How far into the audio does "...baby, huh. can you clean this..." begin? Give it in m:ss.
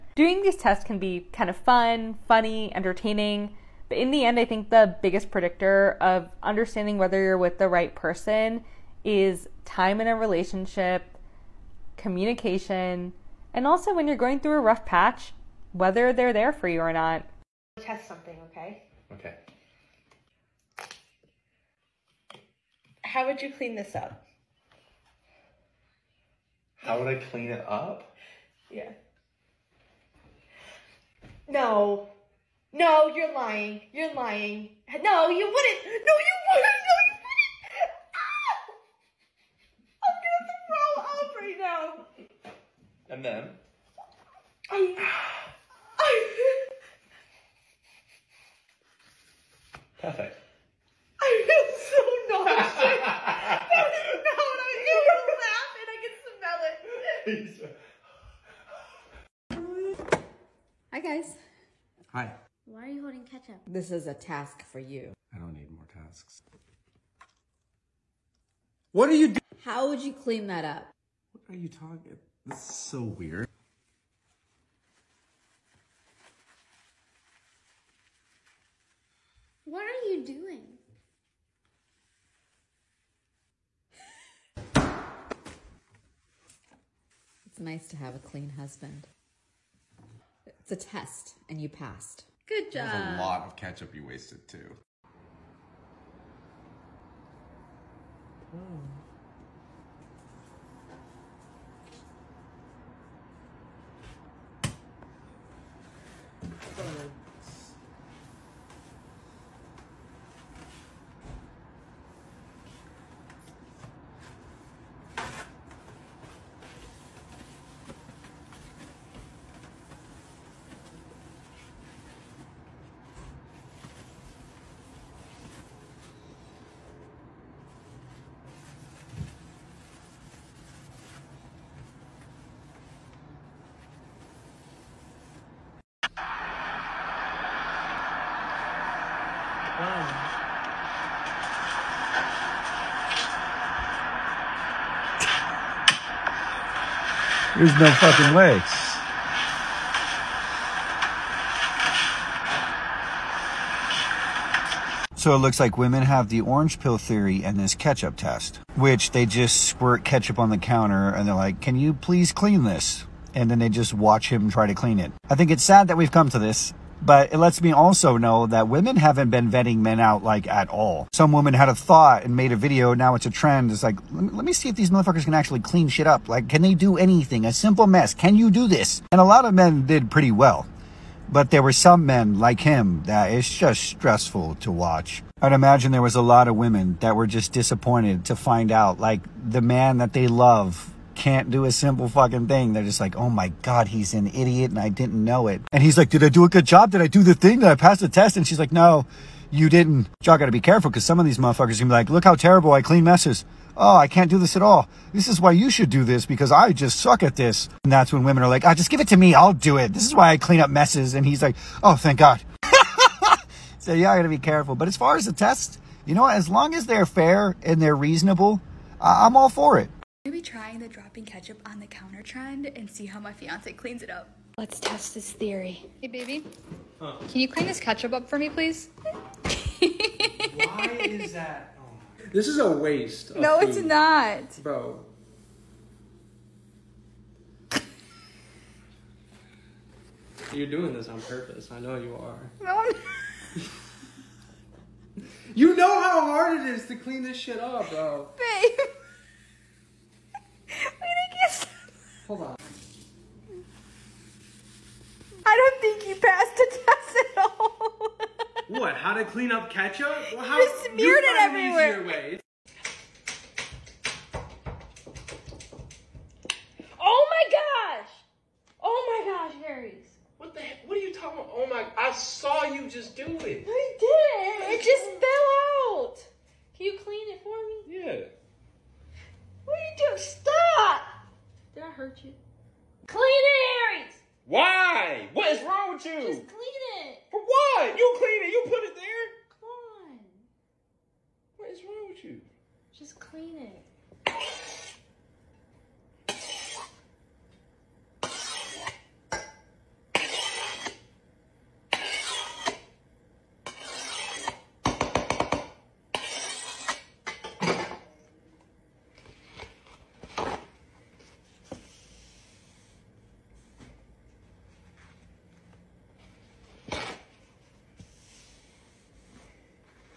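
3:46.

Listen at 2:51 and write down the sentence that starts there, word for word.
Some woman had a thought and made a video.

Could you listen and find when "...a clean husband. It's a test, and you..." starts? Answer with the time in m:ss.
1:28.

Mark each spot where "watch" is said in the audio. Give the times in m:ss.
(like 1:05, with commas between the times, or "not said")
2:43, 3:04.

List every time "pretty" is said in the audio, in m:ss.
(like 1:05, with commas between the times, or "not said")
3:00.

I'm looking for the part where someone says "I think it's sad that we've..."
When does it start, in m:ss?
2:45.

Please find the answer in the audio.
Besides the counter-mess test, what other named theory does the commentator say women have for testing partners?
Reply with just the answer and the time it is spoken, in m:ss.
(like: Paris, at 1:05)
orange pill theory, at 2:36.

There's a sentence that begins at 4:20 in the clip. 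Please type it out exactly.
Well, how, you smeared you it everywhere.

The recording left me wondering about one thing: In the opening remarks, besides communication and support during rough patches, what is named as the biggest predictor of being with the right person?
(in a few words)
time in a relationship.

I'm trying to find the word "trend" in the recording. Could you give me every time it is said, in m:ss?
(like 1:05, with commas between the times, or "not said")
2:53, 3:42.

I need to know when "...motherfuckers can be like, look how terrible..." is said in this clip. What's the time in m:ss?
3:21.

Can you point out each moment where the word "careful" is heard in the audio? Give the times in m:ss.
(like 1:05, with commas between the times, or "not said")
3:20, 3:34.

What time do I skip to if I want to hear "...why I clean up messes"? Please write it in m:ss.
3:30.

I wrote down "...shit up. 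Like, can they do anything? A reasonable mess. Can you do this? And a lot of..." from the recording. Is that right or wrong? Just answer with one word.
wrong.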